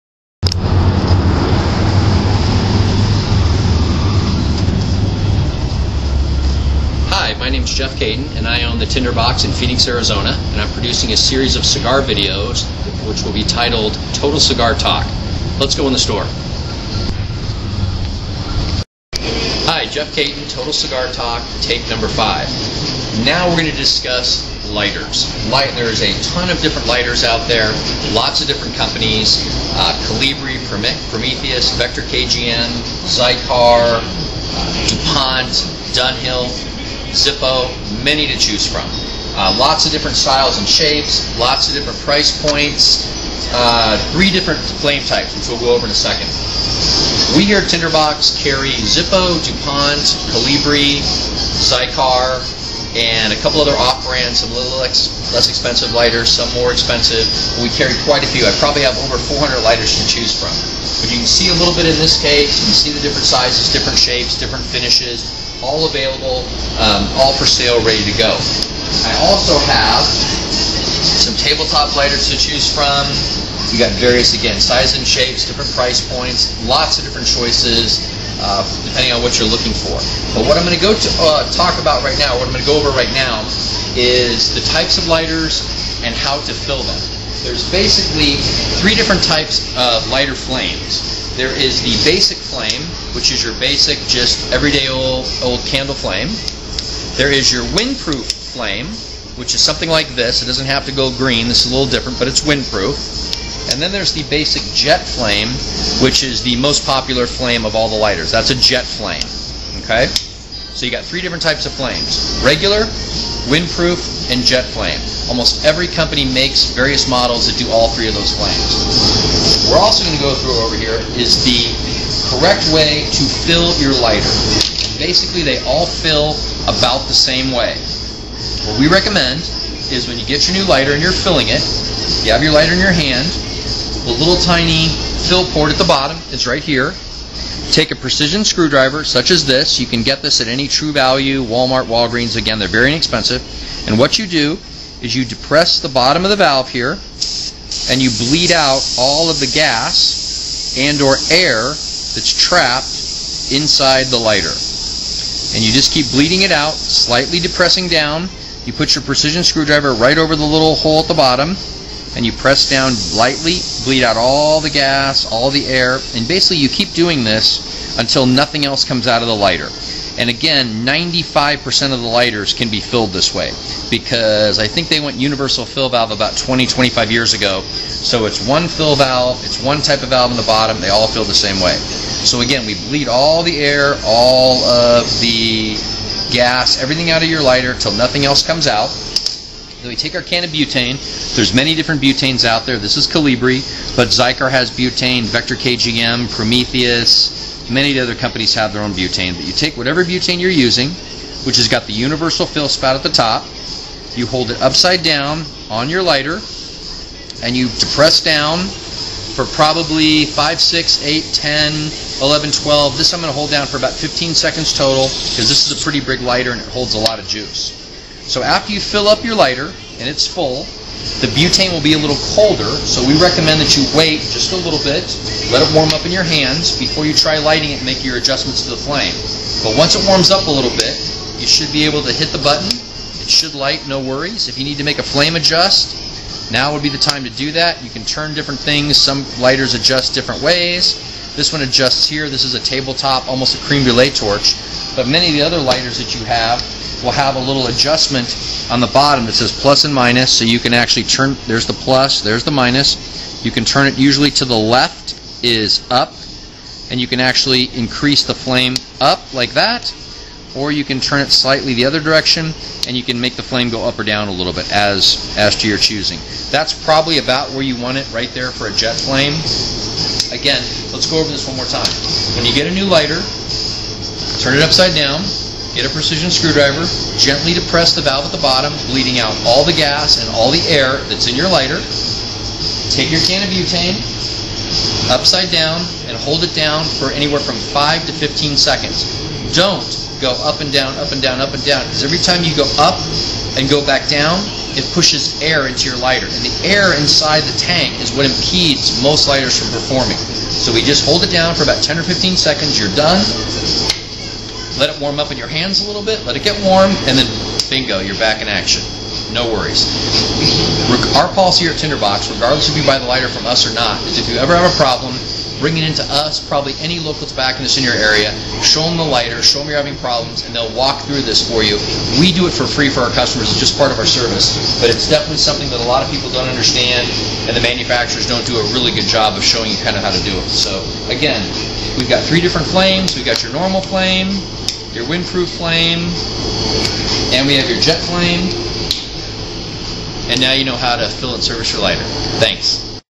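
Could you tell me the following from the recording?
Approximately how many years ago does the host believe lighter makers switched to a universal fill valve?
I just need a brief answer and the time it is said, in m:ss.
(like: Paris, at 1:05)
20, 25 years, at 2:56.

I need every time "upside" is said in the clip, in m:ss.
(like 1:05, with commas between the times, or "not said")
3:24, 4:34, 4:45.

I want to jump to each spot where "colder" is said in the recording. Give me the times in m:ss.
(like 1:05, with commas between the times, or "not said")
3:42.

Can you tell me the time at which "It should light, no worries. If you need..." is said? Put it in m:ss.
3:52.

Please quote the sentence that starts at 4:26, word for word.
That's probably about where you want it right there for a jet flame.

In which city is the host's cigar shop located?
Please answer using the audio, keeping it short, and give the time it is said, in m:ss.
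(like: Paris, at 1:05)
Phoenix, at 0:09.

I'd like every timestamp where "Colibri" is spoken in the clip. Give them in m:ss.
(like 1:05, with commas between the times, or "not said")
0:30, 0:50, 3:13.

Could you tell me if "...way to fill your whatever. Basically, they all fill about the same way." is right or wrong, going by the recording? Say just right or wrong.
wrong.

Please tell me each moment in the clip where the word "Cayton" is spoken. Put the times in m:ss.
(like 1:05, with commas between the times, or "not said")
0:07, 0:20.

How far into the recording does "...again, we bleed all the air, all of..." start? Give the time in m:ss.
3:02.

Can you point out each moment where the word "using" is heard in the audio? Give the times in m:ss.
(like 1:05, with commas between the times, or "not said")
3:20.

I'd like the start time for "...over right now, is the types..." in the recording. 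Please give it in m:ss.
1:22.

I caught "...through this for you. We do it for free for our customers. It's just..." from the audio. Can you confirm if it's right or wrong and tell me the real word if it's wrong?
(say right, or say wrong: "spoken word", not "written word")
right.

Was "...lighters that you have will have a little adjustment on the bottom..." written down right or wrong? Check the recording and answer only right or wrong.
right.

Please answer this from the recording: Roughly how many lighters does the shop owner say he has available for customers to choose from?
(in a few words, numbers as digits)
over 400.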